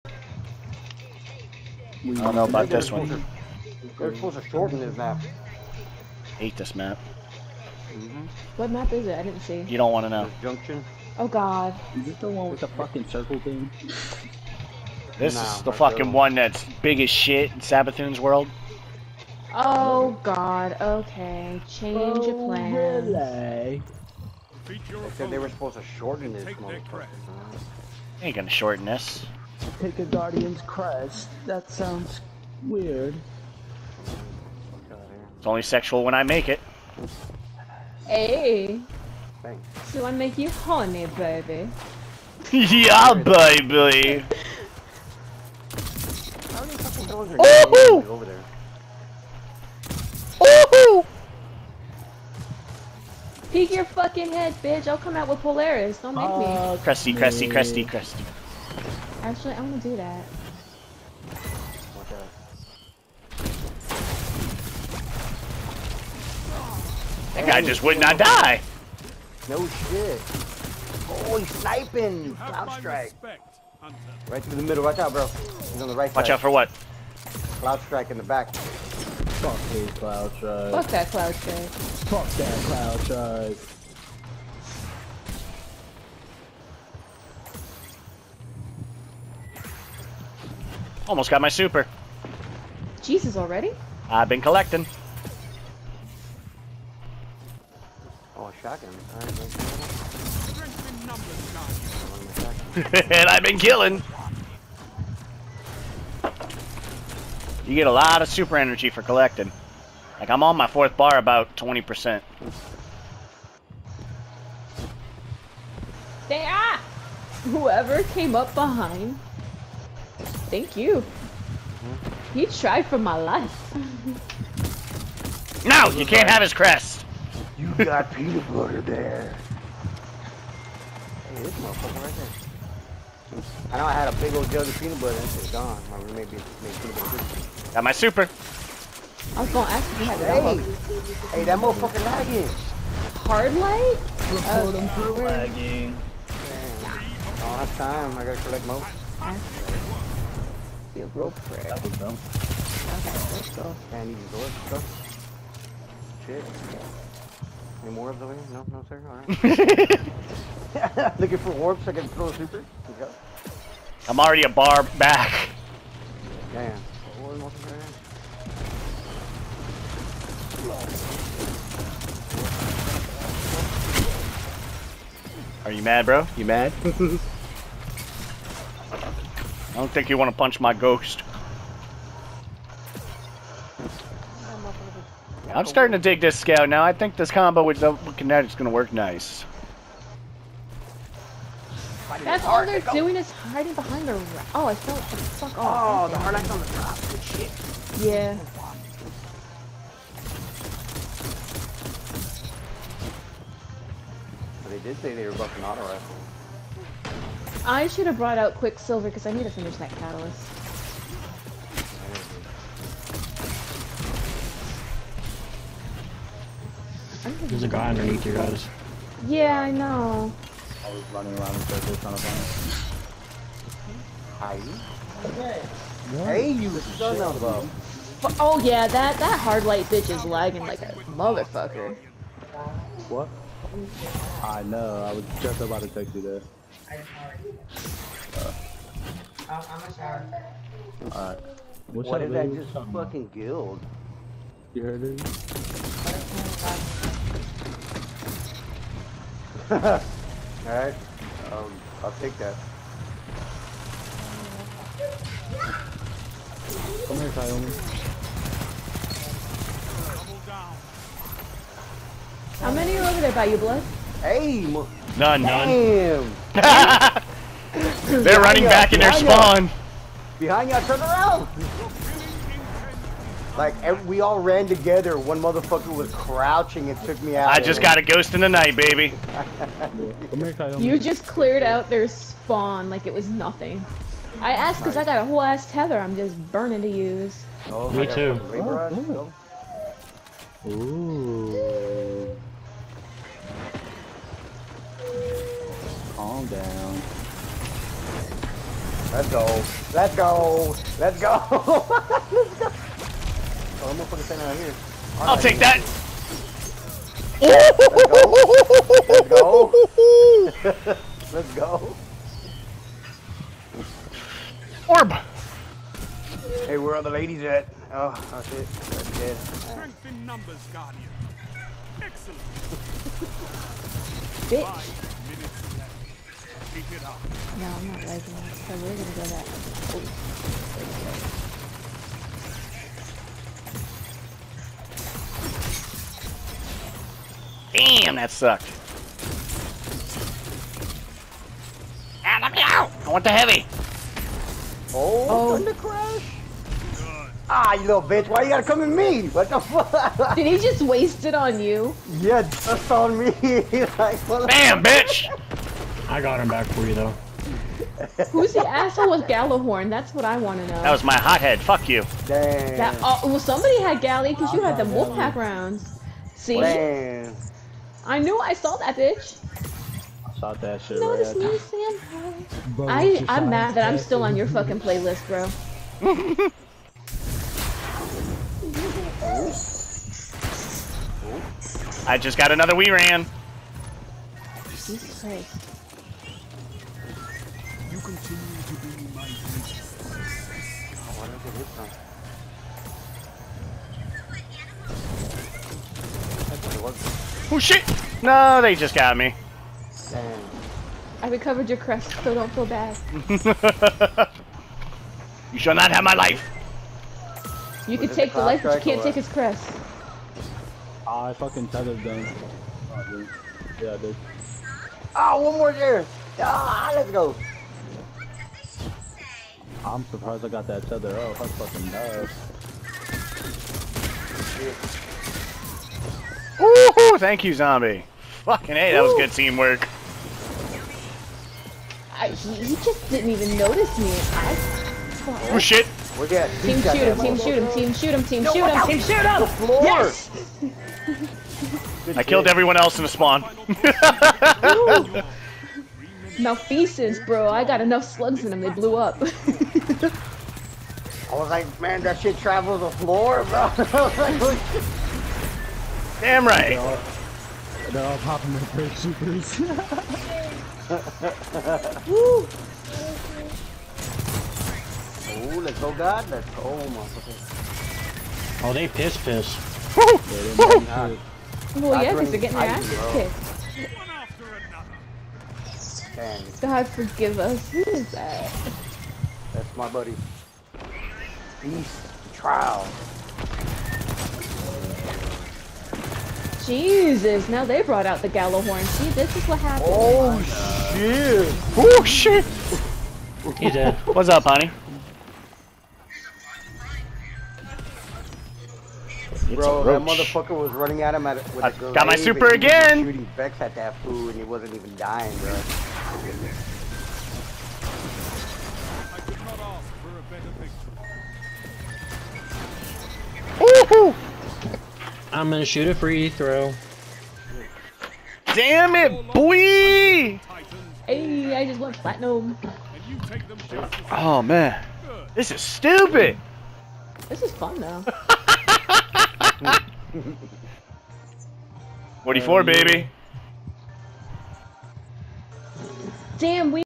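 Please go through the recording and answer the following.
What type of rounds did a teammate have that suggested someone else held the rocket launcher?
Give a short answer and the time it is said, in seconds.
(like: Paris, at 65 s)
Wolfpack rounds, at 364 s.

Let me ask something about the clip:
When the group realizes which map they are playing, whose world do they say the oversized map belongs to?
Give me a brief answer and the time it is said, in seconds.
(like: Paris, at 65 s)
Savathûn, at 17 s.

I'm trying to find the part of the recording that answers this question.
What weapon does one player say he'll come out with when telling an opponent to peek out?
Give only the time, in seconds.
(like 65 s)
55 s.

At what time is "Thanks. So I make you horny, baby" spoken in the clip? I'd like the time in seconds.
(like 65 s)
39 s.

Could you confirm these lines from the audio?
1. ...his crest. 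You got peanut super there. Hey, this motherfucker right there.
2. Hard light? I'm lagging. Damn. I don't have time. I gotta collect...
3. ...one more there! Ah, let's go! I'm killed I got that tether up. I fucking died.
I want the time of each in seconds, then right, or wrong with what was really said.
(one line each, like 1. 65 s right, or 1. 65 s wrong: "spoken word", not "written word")
1. 126 s wrong: "butter", not "super"
2. 143 s right
3. 415 s wrong: "surprised", not "killed".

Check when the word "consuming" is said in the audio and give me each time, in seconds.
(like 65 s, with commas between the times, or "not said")
not said.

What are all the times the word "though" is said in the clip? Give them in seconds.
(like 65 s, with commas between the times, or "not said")
356 s, 527 s.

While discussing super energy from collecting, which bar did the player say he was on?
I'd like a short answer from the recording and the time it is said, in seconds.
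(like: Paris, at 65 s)
Fourth, at 110 s.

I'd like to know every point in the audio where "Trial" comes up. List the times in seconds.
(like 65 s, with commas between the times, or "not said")
482 s.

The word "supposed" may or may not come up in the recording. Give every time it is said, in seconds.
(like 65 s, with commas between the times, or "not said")
4 s, 25 s.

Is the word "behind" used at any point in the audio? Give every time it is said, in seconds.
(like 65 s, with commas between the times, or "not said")
118 s, 193 s, 270 s.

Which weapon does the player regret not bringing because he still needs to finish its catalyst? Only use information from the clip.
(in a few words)
Quicksilver.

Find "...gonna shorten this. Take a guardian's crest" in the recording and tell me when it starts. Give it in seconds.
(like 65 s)
28 s.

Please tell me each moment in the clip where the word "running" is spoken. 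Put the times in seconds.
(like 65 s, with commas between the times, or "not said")
221 s, 268 s, 500 s.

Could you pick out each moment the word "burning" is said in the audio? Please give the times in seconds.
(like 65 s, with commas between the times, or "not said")
286 s.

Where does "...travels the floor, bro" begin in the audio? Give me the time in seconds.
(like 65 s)
452 s.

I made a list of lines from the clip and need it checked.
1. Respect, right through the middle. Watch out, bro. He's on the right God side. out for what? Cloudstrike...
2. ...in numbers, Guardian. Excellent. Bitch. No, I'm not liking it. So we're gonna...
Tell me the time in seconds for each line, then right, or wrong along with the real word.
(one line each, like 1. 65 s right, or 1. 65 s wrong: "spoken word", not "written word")
1. 73 s wrong: "Watch", not "God"
2. 320 s right.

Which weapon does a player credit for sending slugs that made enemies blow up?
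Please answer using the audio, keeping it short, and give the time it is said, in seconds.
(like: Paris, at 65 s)
Malfeasance, at 446 s.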